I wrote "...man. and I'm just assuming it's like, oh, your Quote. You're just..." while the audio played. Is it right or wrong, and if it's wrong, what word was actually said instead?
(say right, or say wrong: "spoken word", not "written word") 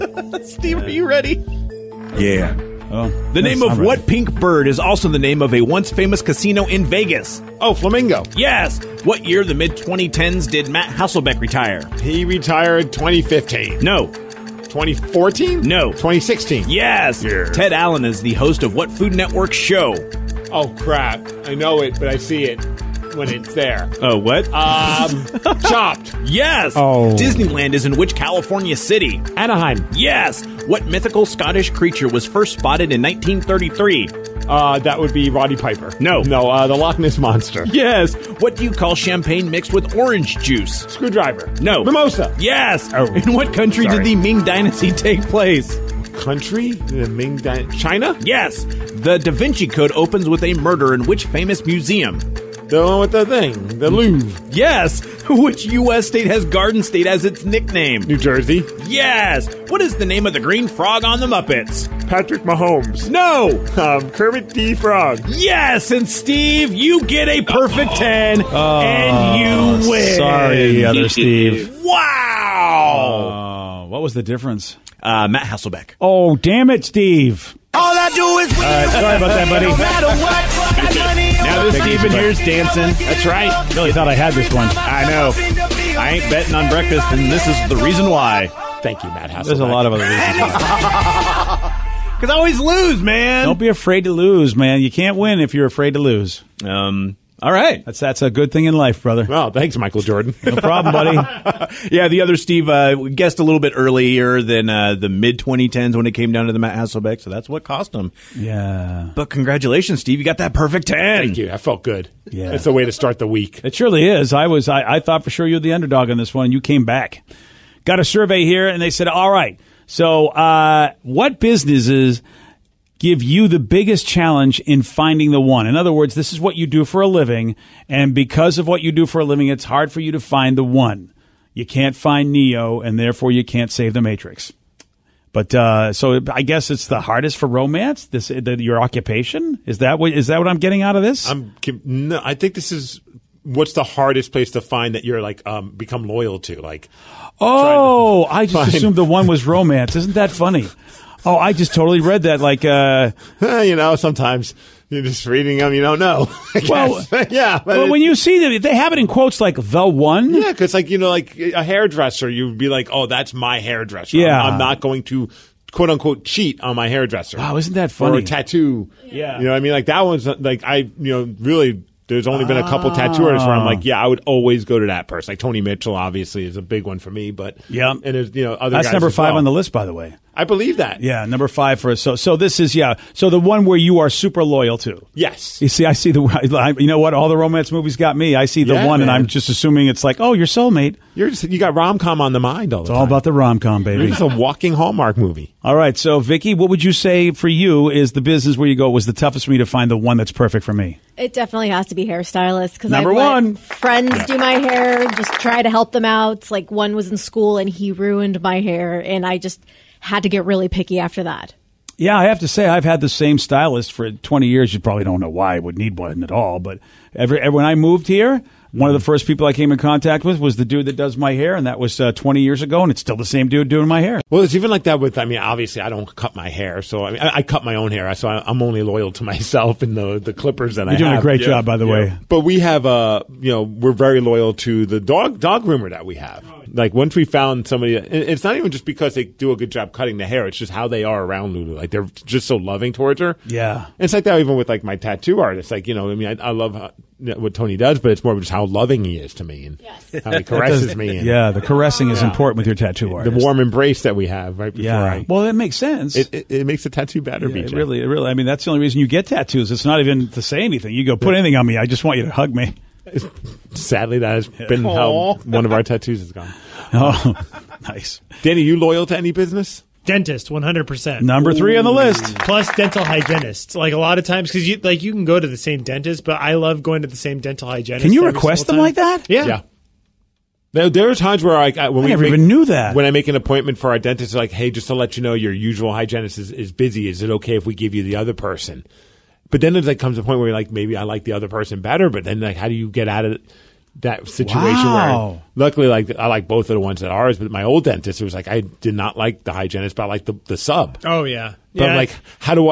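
wrong: "soulmate", not "Quote".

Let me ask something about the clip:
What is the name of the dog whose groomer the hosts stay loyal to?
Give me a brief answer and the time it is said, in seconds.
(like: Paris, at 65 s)
Lulu, at 241 s.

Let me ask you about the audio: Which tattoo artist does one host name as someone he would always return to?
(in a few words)
Tony Mitchell.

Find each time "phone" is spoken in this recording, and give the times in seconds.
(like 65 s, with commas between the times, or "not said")
not said.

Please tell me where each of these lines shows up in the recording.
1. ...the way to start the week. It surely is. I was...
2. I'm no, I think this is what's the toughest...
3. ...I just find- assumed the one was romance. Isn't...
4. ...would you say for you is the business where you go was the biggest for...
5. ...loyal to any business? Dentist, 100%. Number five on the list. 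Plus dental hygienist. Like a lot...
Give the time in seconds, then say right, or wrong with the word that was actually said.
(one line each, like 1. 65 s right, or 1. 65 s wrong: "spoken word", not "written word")
1. 112 s right
2. 141 s wrong: "hardest", not "toughest"
3. 148 s right
4. 196 s wrong: "toughest", not "biggest"
5. 268 s wrong: "three", not "five".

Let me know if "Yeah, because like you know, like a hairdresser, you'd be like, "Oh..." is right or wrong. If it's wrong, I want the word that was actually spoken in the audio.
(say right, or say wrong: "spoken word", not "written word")
right.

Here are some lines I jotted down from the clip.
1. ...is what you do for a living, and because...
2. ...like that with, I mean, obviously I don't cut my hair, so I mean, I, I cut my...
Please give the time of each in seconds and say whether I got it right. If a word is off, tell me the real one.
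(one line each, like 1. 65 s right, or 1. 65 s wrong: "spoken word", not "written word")
1. 126 s right
2. 224 s right.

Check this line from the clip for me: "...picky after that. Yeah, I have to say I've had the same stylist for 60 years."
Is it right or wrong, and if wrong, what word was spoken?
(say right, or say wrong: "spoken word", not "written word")
wrong: "20", not "60".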